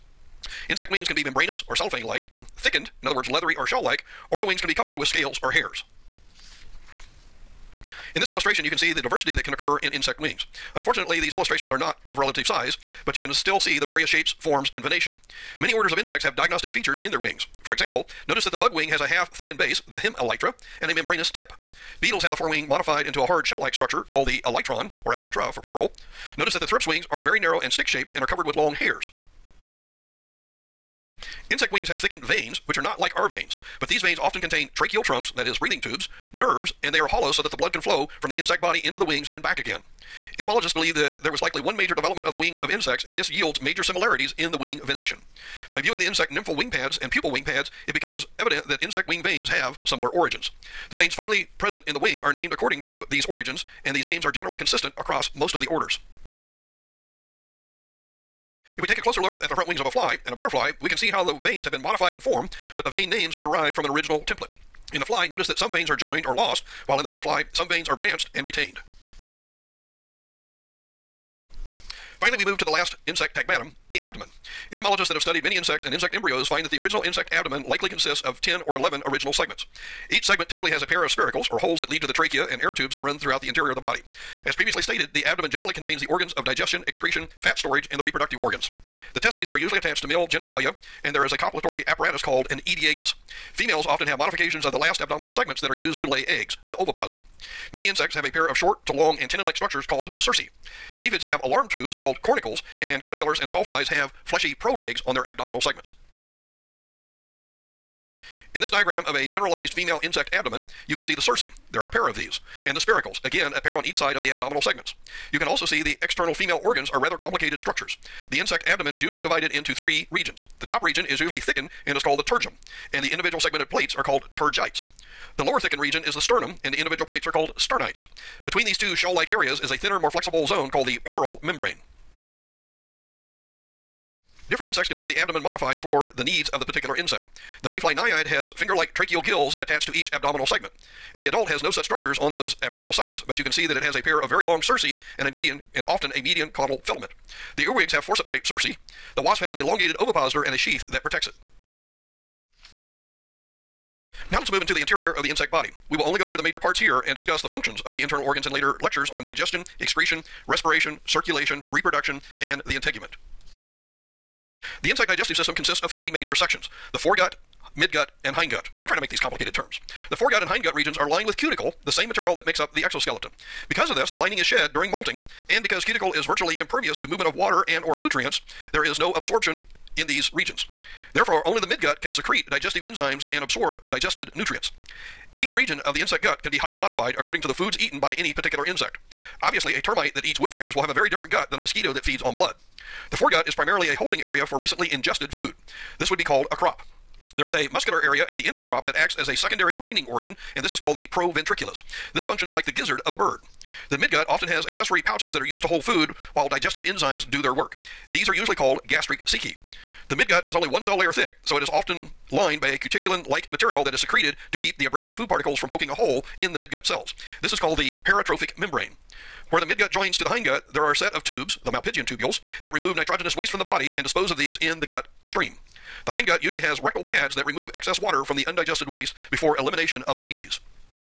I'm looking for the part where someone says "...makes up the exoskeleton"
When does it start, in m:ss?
2:52.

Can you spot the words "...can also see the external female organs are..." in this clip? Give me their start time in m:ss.
1:55.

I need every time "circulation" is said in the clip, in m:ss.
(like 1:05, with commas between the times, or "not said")
2:41.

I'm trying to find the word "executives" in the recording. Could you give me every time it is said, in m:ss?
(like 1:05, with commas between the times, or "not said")
not said.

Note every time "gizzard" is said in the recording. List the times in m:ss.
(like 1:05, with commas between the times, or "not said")
3:22.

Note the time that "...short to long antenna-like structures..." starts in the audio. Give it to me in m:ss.
1:38.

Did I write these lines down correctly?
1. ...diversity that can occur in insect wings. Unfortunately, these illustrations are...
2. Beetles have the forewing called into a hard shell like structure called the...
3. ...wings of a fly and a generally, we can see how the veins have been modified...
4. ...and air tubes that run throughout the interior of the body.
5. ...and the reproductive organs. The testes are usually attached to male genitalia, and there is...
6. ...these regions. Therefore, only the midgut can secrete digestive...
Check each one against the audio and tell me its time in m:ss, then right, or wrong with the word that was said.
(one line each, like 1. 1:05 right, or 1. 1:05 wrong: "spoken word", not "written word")
1. 0:09 right
2. 0:22 wrong: "modified", not "called"
3. 0:59 wrong: "butterfly", not "generally"
4. 1:22 right
5. 1:27 right
6. 3:00 right.